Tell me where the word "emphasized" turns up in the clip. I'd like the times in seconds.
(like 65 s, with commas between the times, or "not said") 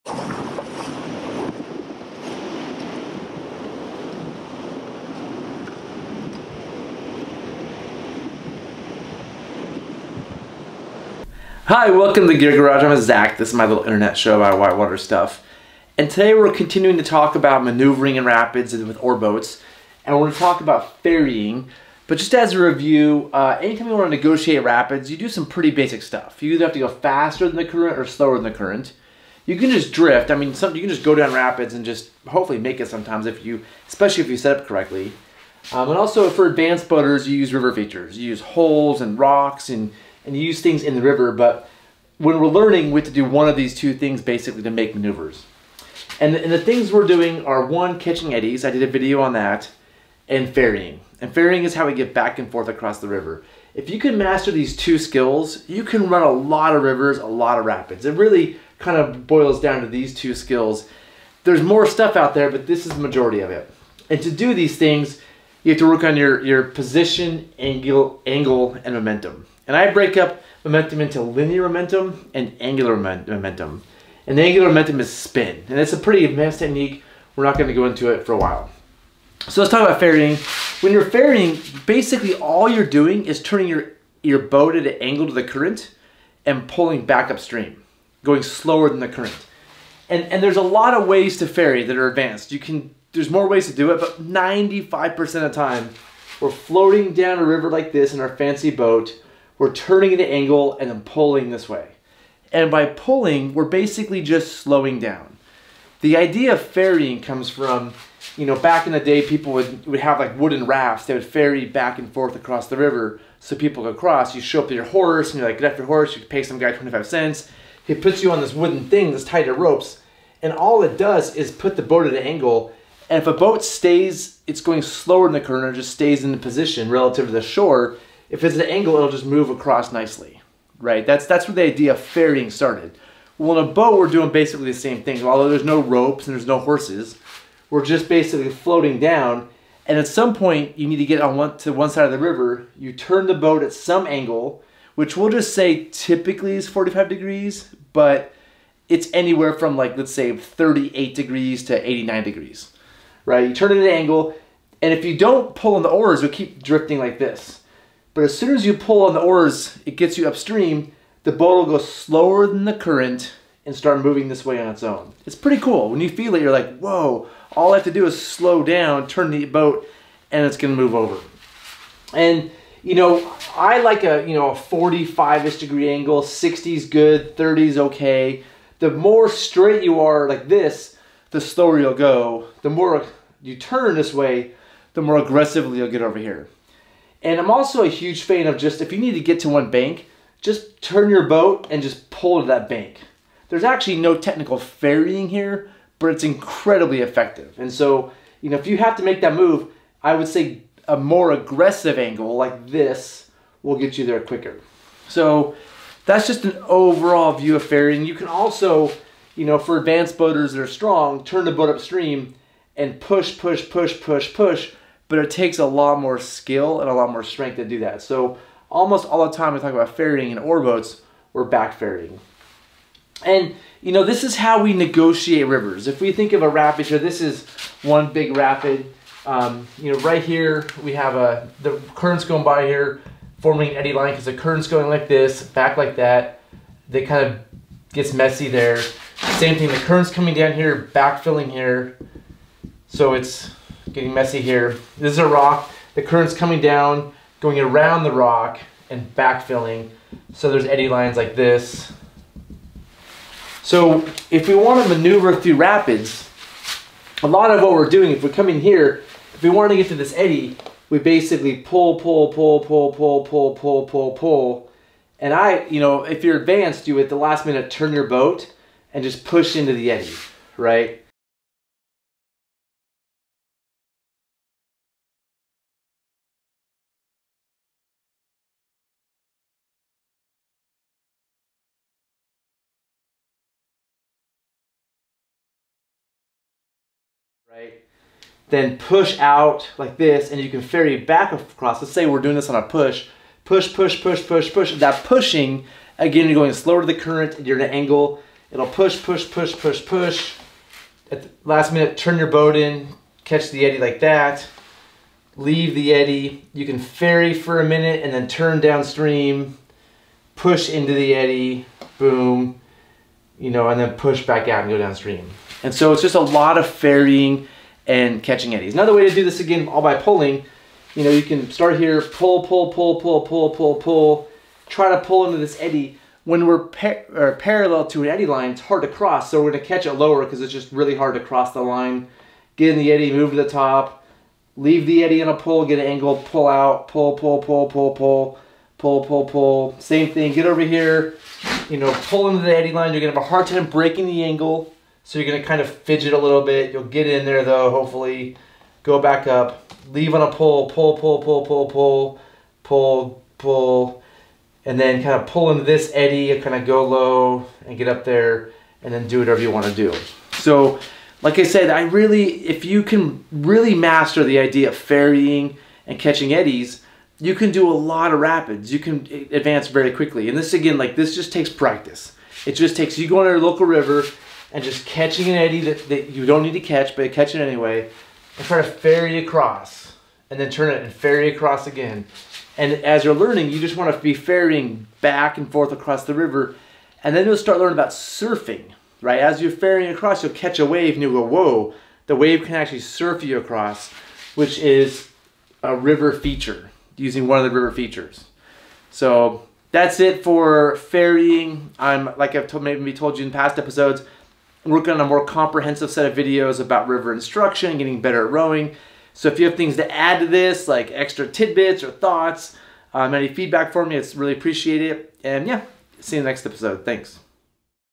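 not said.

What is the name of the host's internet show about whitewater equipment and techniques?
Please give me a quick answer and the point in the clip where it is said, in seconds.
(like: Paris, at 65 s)
Gear Garage, at 12 s.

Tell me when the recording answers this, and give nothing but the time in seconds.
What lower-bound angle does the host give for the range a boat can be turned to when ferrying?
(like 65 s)
150 s.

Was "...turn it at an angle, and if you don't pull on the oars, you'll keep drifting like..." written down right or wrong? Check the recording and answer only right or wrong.
right.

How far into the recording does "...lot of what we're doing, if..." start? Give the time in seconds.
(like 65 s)
257 s.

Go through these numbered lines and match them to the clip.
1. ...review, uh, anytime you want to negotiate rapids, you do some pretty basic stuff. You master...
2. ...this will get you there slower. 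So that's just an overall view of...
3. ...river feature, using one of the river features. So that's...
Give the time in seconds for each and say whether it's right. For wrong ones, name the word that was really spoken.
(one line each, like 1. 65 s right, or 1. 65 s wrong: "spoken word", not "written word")
1. 22 s wrong: "either", not "master"
2. 202 s wrong: "quicker", not "slower"
3. 395 s right.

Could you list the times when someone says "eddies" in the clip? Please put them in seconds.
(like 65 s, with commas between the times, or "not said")
48 s, 318 s, 366 s.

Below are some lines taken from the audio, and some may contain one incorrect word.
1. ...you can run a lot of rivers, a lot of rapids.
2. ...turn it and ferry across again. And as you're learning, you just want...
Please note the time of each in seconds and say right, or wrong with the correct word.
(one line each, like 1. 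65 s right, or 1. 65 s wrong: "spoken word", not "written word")
1. 55 s right
2. 380 s right.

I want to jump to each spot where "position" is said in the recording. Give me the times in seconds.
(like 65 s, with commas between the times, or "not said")
66 s, 126 s.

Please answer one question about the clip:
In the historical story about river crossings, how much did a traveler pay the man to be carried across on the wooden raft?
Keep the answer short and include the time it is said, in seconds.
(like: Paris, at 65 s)
25 cents, at 116 s.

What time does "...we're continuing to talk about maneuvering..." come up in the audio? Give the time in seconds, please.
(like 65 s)
16 s.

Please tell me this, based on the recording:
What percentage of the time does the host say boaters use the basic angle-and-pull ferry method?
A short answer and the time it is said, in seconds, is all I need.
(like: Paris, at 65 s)
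95%, at 94 s.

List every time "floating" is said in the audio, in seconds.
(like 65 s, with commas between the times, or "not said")
96 s, 138 s.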